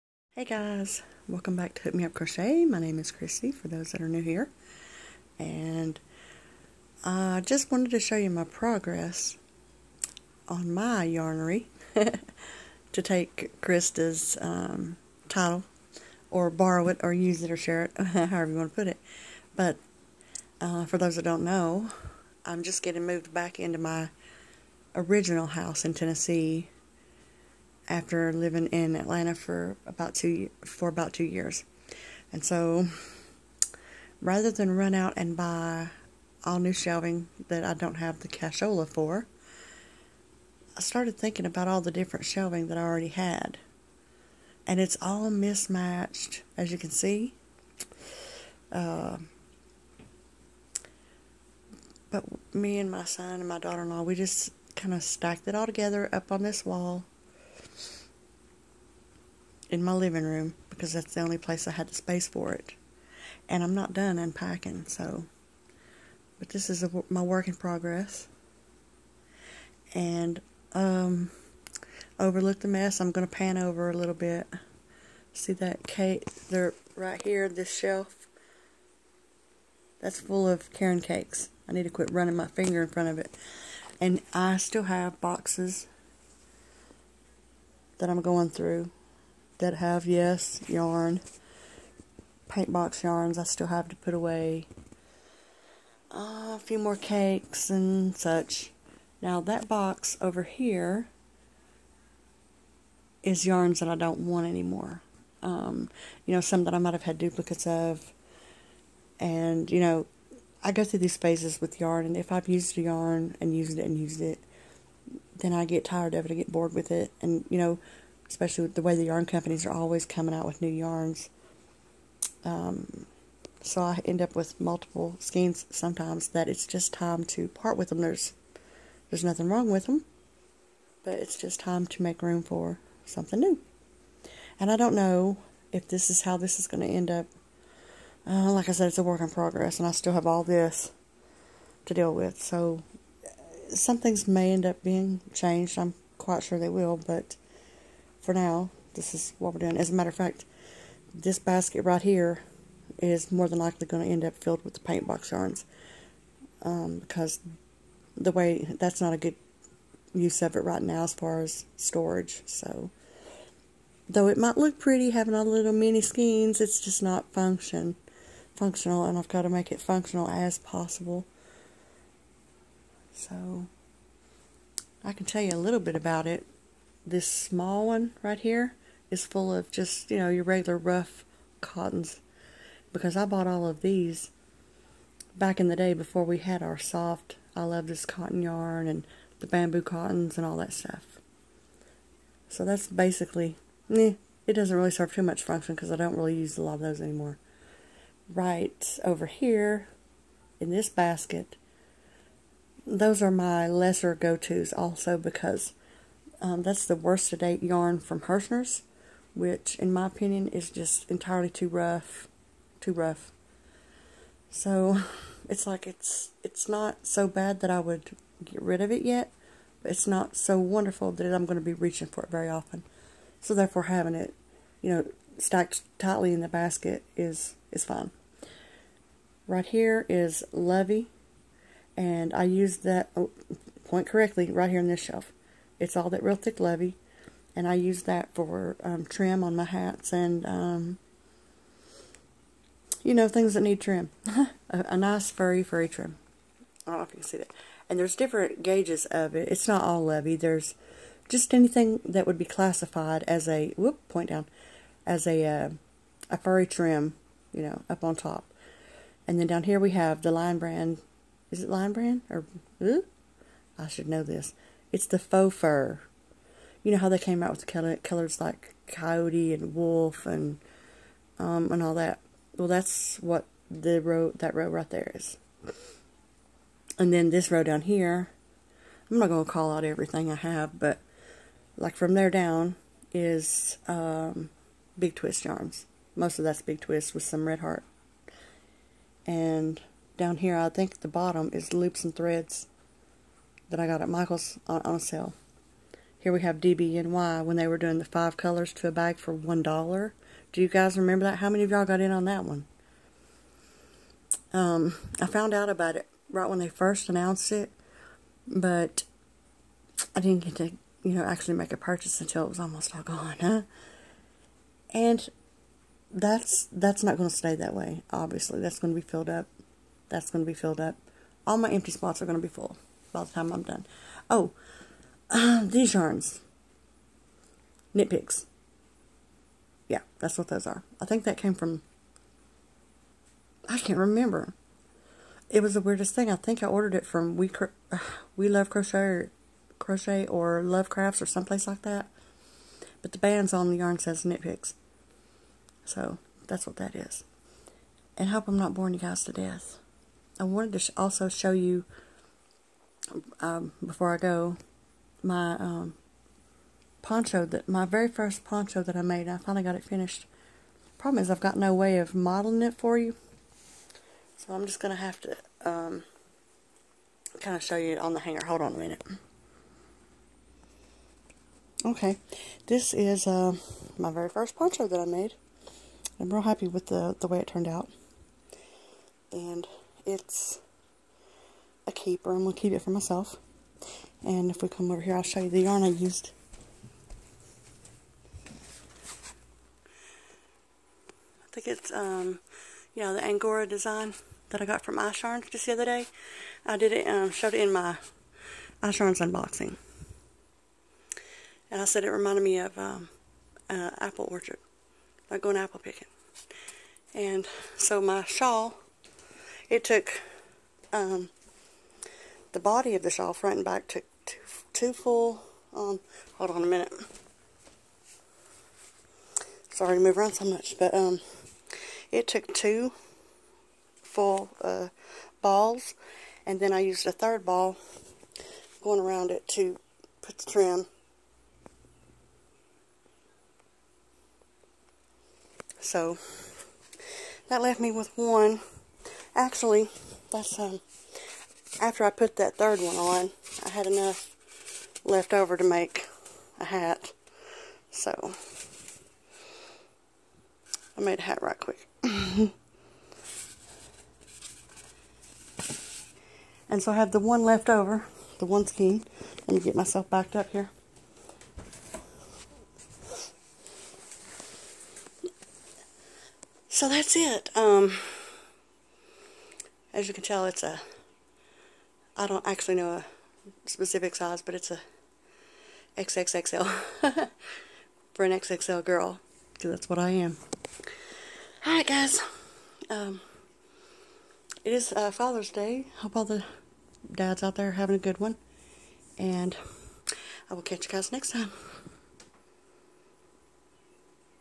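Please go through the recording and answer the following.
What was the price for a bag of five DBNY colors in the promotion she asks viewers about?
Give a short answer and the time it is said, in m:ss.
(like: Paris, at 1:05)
$1, at 4:59.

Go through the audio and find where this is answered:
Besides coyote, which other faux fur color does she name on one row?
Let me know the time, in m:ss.
4:29.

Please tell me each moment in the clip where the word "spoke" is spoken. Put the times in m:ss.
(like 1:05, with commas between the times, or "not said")
not said.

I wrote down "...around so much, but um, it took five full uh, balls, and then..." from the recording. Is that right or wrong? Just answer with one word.
wrong.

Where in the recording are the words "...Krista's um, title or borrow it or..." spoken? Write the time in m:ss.
0:13.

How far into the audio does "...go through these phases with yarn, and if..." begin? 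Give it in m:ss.
1:50.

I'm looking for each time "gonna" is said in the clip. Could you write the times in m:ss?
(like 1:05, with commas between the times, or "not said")
4:39, 6:04.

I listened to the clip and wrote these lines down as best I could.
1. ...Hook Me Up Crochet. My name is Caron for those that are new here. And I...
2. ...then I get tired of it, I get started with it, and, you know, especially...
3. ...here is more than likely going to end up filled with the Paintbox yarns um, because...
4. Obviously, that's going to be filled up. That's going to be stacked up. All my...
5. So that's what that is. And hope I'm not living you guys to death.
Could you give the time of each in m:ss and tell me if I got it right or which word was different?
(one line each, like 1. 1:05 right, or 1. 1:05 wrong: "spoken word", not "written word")
1. 0:01 wrong: "Kristie", not "Caron"
2. 1:55 wrong: "bored", not "started"
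3. 2:32 right
4. 5:18 wrong: "filled", not "stacked"
5. 5:45 wrong: "boring", not "living".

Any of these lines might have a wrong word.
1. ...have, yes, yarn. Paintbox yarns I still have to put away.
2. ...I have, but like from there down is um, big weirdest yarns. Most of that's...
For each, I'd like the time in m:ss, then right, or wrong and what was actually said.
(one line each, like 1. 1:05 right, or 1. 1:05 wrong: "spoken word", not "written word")
1. 1:29 right
2. 4:40 wrong: "twist", not "weirdest".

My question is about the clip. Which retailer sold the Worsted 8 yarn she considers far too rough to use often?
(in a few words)
Herrschner's.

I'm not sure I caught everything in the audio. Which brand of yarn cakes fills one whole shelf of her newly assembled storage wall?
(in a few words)
Caron.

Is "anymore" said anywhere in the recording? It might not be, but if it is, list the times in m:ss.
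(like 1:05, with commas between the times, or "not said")
1:44, 3:17.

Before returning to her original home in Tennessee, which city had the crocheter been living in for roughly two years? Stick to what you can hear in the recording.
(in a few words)
Atlanta.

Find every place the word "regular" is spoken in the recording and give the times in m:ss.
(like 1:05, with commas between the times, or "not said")
3:00.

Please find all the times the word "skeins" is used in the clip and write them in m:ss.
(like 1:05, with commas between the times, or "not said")
2:05, 2:46, 7:38.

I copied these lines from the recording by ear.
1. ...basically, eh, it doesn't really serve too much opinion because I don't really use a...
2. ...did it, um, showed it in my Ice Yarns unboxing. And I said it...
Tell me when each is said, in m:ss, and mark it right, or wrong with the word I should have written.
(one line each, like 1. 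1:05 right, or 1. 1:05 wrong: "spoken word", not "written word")
1. 3:12 wrong: "function", not "opinion"
2. 6:36 right.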